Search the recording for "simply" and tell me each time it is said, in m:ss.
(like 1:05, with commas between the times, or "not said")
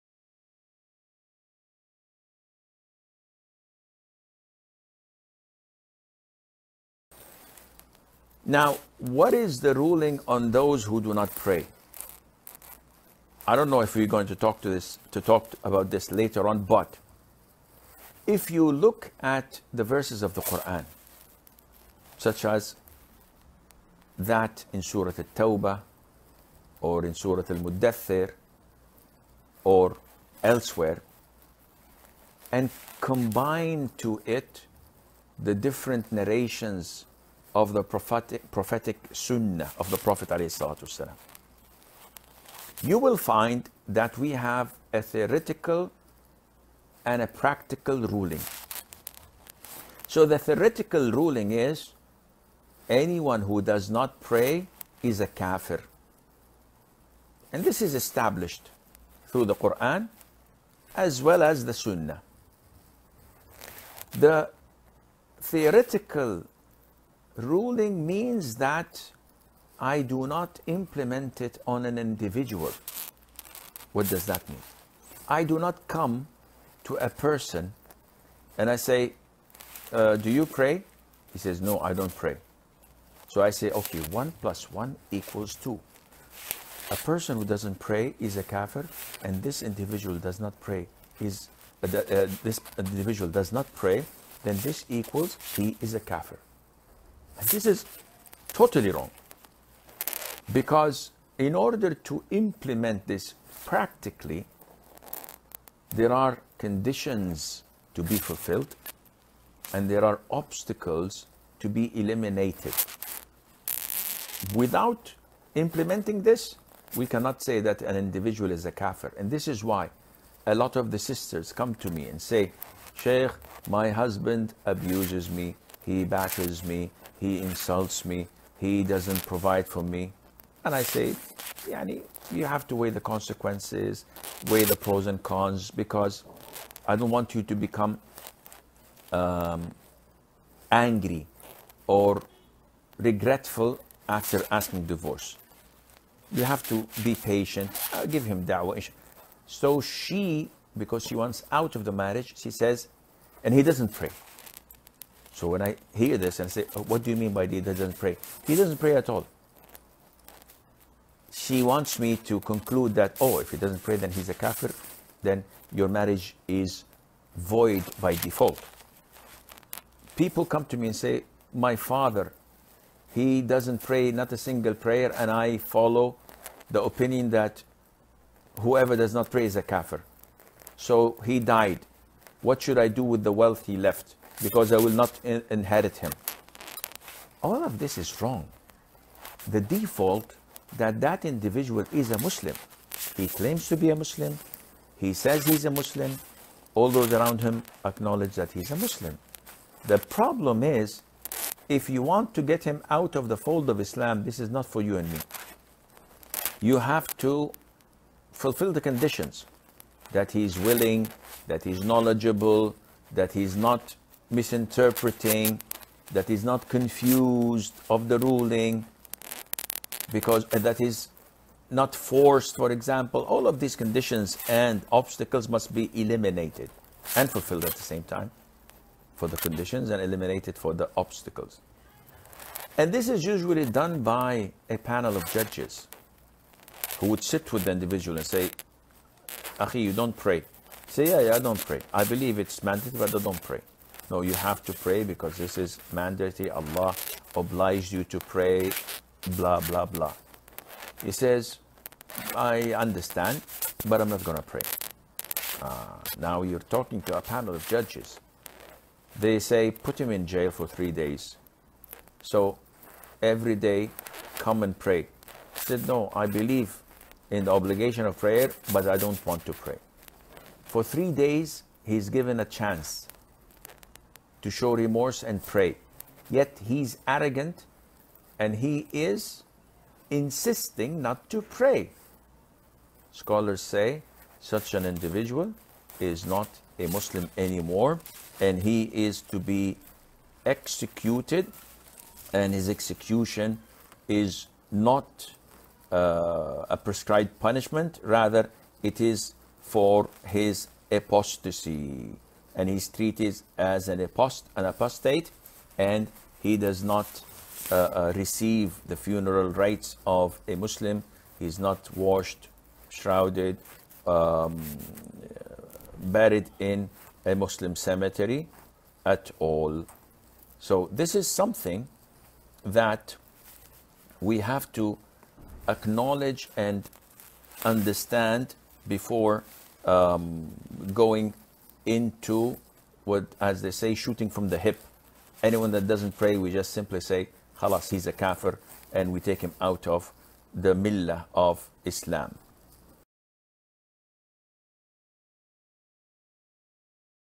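5:36.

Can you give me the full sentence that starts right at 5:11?
He's not washed, shrouded, um, buried in a Muslim cemetery at all.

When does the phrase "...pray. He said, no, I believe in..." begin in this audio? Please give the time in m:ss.
4:24.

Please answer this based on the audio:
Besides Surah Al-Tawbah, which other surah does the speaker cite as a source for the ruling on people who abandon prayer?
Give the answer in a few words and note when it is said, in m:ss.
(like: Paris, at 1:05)
Al-Muddathir, at 0:27.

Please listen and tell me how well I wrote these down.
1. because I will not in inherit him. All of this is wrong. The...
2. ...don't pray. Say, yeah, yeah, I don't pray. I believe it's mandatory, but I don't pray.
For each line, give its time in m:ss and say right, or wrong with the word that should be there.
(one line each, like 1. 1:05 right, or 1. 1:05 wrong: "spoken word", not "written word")
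1. 3:04 right
2. 3:59 right.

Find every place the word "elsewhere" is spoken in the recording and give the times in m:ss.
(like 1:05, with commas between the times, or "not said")
0:30.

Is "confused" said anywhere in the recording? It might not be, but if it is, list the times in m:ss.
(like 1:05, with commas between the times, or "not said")
3:36.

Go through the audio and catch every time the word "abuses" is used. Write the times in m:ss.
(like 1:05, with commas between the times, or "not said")
2:04.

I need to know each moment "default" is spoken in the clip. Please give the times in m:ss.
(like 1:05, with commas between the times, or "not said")
2:48, 3:09.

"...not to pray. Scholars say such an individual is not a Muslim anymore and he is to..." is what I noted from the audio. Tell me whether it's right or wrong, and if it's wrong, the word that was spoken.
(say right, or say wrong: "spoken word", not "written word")
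right.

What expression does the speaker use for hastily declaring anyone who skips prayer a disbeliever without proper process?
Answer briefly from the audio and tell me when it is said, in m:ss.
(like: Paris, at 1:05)
Shooting from the hip, at 5:33.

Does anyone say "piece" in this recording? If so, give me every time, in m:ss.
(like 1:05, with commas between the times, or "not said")
not said.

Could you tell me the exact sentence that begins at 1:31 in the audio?
Is uh, uh, this individual does not pray, then this equals he is a kafir.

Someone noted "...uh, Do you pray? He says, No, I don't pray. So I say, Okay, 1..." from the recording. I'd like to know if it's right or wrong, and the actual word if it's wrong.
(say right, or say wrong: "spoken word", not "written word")
right.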